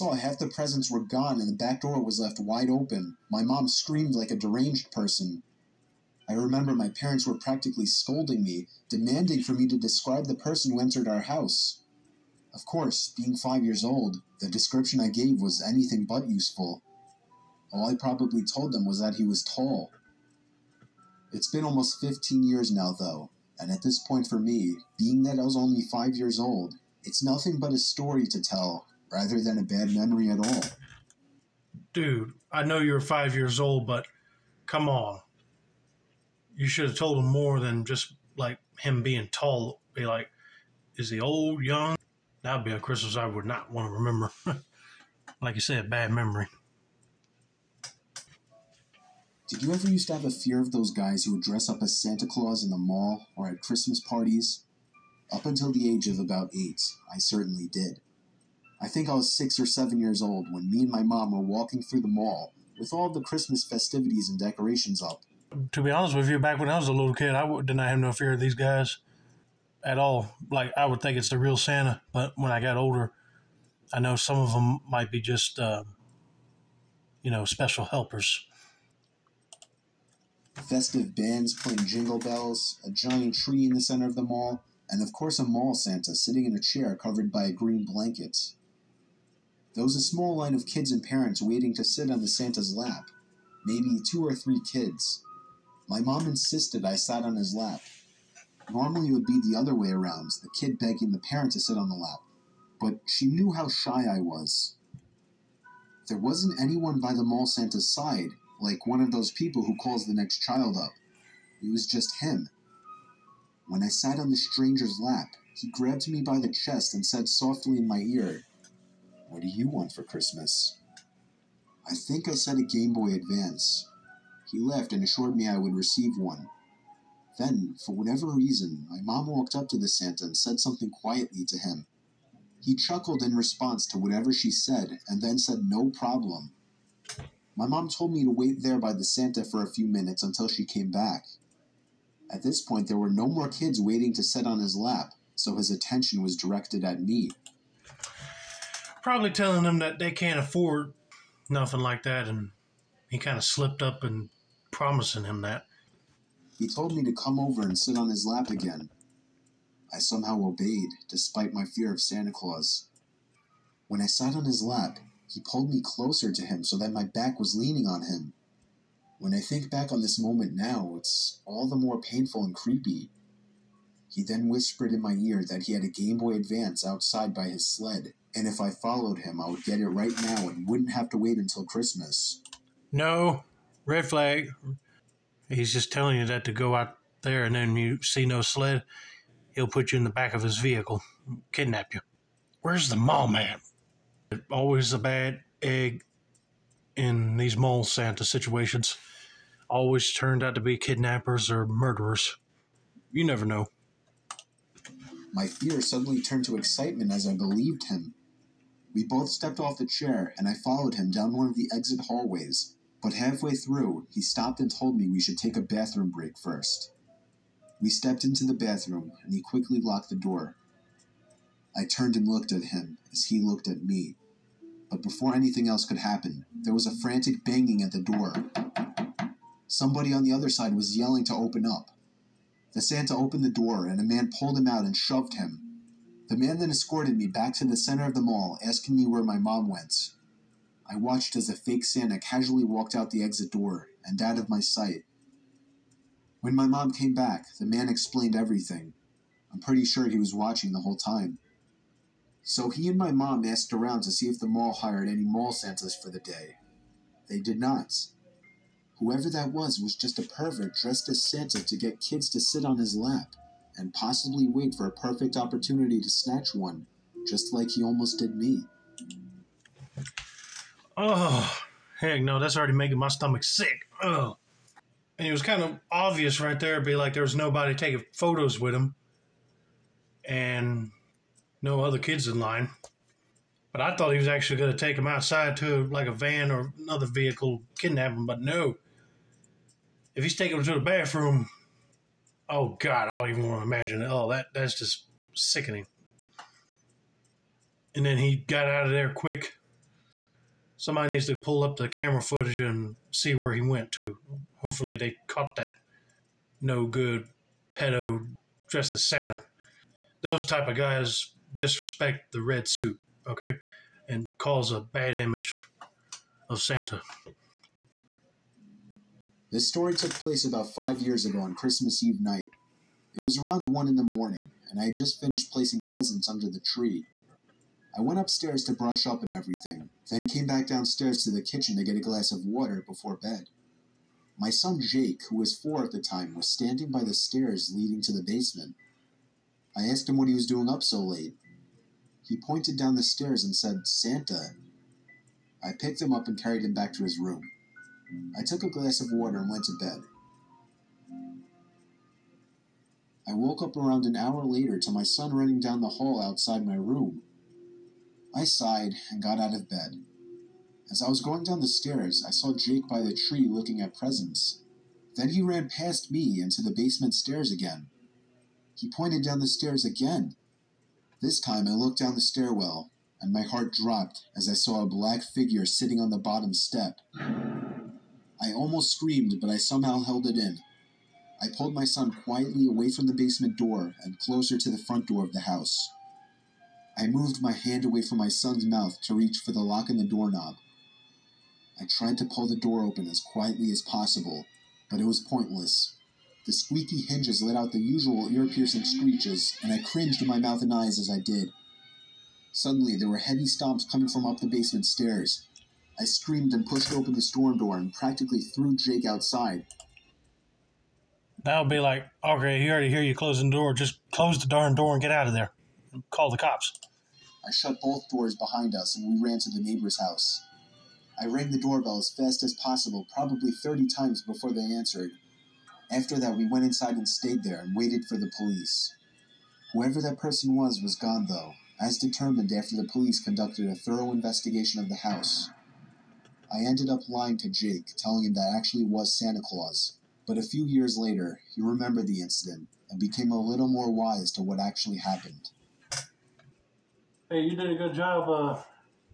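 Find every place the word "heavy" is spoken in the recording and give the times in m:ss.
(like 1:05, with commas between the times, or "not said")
6:43.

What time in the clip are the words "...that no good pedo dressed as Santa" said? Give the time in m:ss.
5:05.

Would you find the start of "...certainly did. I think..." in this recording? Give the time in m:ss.
0:57.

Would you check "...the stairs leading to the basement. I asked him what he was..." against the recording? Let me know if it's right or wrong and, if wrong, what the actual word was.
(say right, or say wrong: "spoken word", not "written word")
right.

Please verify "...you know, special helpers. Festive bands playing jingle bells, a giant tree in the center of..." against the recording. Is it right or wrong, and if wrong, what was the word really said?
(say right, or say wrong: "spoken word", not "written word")
right.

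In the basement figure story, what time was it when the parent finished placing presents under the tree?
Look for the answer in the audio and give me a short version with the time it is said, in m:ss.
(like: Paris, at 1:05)
1 in the morning, at 5:23.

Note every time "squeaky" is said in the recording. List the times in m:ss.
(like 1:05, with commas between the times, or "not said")
6:36.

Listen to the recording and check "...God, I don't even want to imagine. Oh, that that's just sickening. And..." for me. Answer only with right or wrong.
right.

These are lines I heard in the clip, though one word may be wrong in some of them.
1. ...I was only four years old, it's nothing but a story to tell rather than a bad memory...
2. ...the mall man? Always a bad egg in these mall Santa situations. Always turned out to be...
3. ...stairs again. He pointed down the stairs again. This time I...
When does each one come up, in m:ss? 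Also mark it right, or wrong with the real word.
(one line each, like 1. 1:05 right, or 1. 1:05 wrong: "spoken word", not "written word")
1. 0:25 wrong: "five", not "four"
2. 3:12 right
3. 6:07 right.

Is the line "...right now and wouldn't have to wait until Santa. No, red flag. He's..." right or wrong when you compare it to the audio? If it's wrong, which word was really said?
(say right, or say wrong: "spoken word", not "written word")
wrong: "Christmas", not "Santa".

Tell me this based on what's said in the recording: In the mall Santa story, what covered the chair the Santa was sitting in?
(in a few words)
a green blanket.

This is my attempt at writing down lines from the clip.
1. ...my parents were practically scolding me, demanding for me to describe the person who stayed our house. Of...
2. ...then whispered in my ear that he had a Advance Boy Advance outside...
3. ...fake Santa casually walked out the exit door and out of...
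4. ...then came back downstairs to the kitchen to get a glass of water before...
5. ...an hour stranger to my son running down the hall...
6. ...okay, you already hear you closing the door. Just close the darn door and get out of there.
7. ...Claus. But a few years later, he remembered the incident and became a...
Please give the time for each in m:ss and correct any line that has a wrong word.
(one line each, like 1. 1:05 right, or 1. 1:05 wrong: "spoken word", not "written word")
1. 0:06 wrong: "entered", not "stayed"
2. 2:54 wrong: "Game", not "Advance"
3. 4:01 right
4. 5:30 right
5. 5:54 wrong: "later", not "stranger"
6. 6:52 right
7. 7:19 right.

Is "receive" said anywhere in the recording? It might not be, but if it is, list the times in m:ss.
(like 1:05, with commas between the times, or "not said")
2:05.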